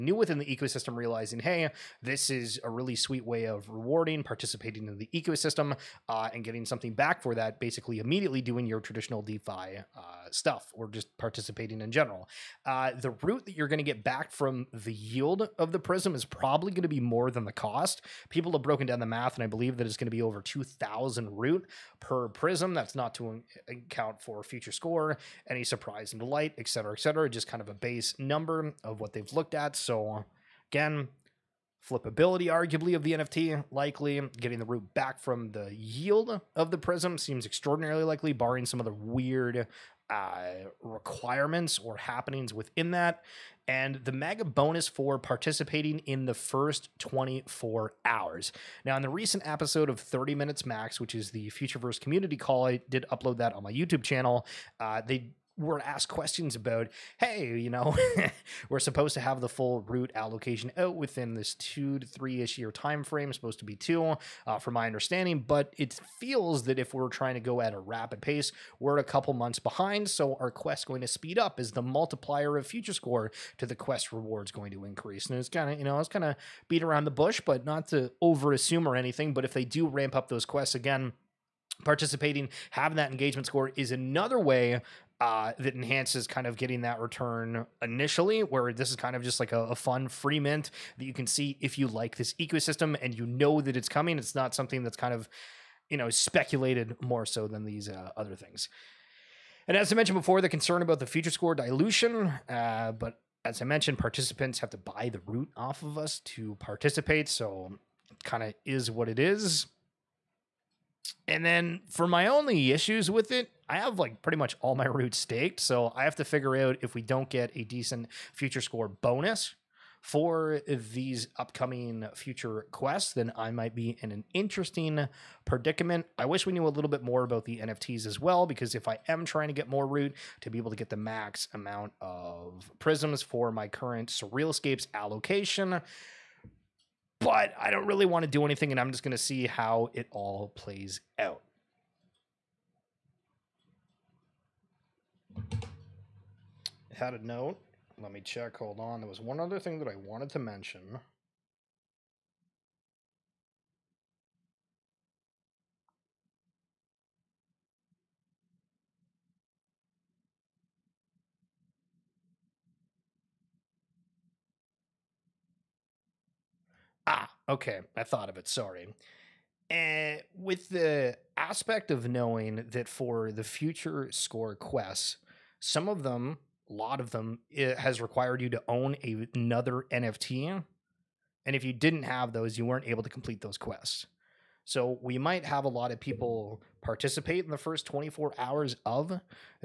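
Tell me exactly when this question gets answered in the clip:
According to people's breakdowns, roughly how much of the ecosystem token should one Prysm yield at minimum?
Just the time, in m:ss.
0:20.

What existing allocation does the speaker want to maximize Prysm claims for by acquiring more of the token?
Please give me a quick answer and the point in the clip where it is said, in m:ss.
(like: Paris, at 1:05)
SurrealScapes, at 2:14.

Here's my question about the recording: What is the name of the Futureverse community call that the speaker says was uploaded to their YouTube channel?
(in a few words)
30 Minutes Max.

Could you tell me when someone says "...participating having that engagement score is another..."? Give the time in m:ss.
1:21.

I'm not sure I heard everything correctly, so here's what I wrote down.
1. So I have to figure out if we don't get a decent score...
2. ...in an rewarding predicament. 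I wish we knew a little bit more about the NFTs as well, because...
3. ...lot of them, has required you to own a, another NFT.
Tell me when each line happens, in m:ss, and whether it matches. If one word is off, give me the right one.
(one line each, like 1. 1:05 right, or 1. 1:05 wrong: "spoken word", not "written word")
1. 1:55 wrong: "future", not "score"
2. 2:04 wrong: "interesting", not "rewarding"
3. 2:56 right.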